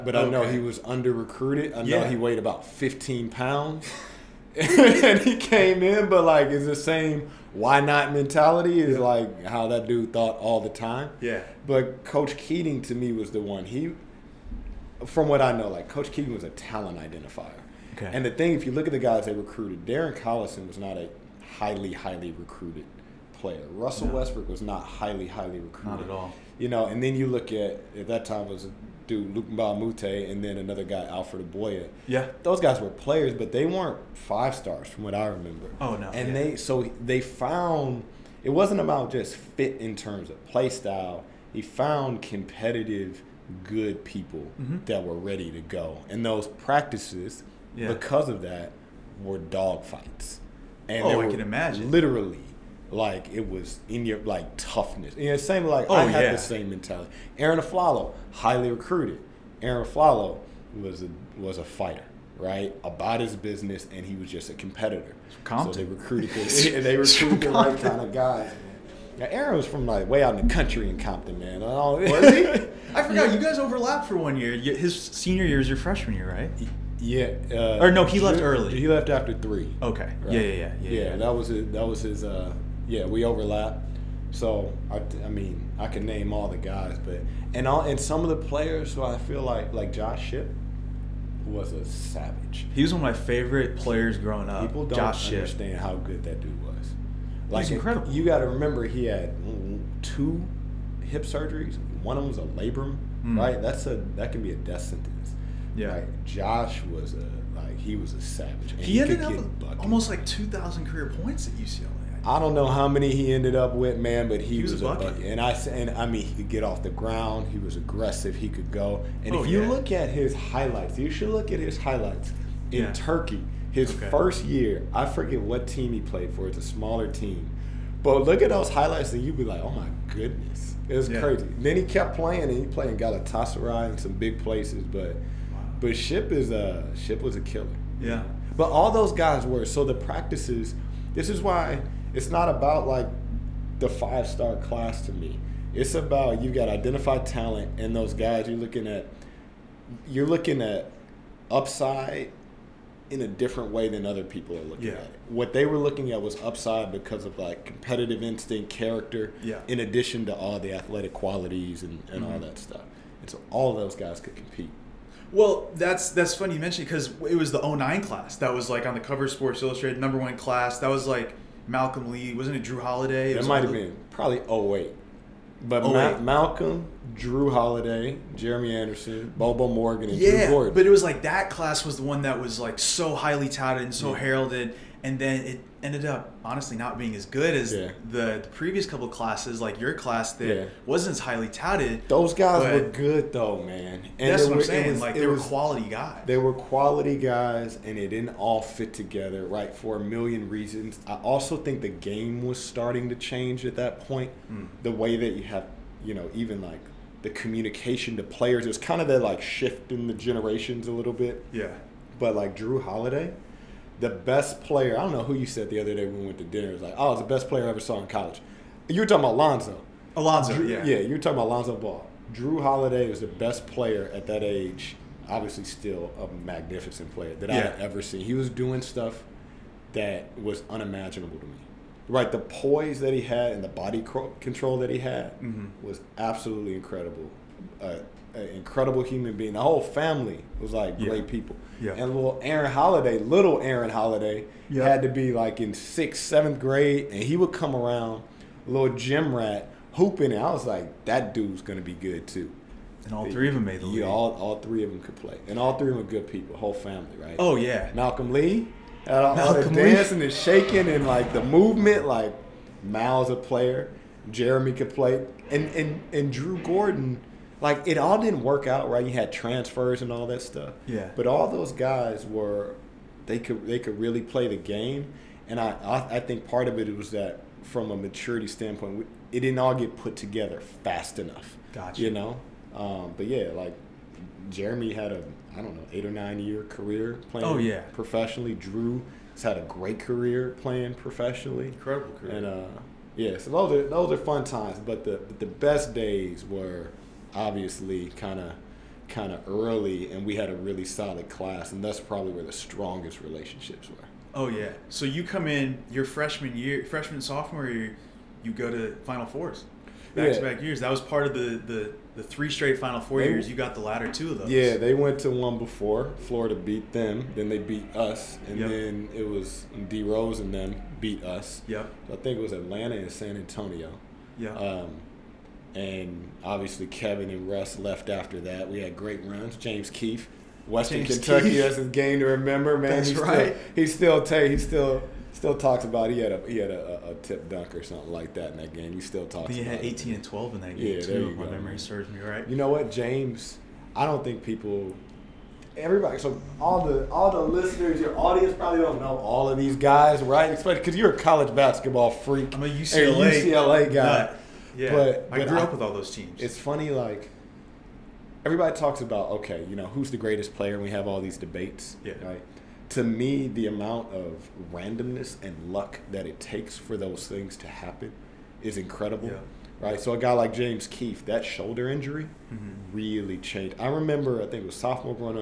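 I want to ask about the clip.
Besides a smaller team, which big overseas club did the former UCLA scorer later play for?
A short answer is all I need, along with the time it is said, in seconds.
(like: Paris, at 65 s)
Galatasaray, at 132 s.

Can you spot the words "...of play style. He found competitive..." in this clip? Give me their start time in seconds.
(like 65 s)
40 s.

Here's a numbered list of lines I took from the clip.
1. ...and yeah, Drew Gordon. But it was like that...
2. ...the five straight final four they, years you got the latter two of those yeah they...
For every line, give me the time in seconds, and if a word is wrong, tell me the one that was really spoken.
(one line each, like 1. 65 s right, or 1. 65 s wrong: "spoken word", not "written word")
1. 180 s right
2. 312 s wrong: "three", not "five".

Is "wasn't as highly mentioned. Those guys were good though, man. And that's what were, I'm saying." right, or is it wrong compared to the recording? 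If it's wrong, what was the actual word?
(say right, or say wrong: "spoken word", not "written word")
wrong: "touted", not "mentioned".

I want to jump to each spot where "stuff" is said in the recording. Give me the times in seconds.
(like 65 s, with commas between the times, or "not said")
162 s, 228 s, 270 s.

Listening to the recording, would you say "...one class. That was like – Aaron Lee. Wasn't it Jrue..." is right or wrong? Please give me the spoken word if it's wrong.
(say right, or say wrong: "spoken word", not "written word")
wrong: "Malcolm", not "Aaron".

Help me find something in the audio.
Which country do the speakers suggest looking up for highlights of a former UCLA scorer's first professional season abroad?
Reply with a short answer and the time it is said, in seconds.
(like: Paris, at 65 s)
Turkey, at 122 s.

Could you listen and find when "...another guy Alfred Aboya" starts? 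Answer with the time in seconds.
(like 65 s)
30 s.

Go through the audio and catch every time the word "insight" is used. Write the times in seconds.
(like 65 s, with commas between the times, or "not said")
not said.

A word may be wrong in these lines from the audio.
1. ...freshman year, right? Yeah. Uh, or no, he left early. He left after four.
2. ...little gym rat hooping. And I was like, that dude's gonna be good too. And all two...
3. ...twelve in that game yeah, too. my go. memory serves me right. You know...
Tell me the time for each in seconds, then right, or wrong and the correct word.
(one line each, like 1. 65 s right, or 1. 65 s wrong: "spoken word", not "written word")
1. 75 s wrong: "three", not "four"
2. 248 s wrong: "three", not "two"
3. 340 s right.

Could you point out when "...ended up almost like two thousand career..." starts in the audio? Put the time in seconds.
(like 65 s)
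109 s.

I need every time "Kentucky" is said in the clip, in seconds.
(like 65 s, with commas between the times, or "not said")
331 s.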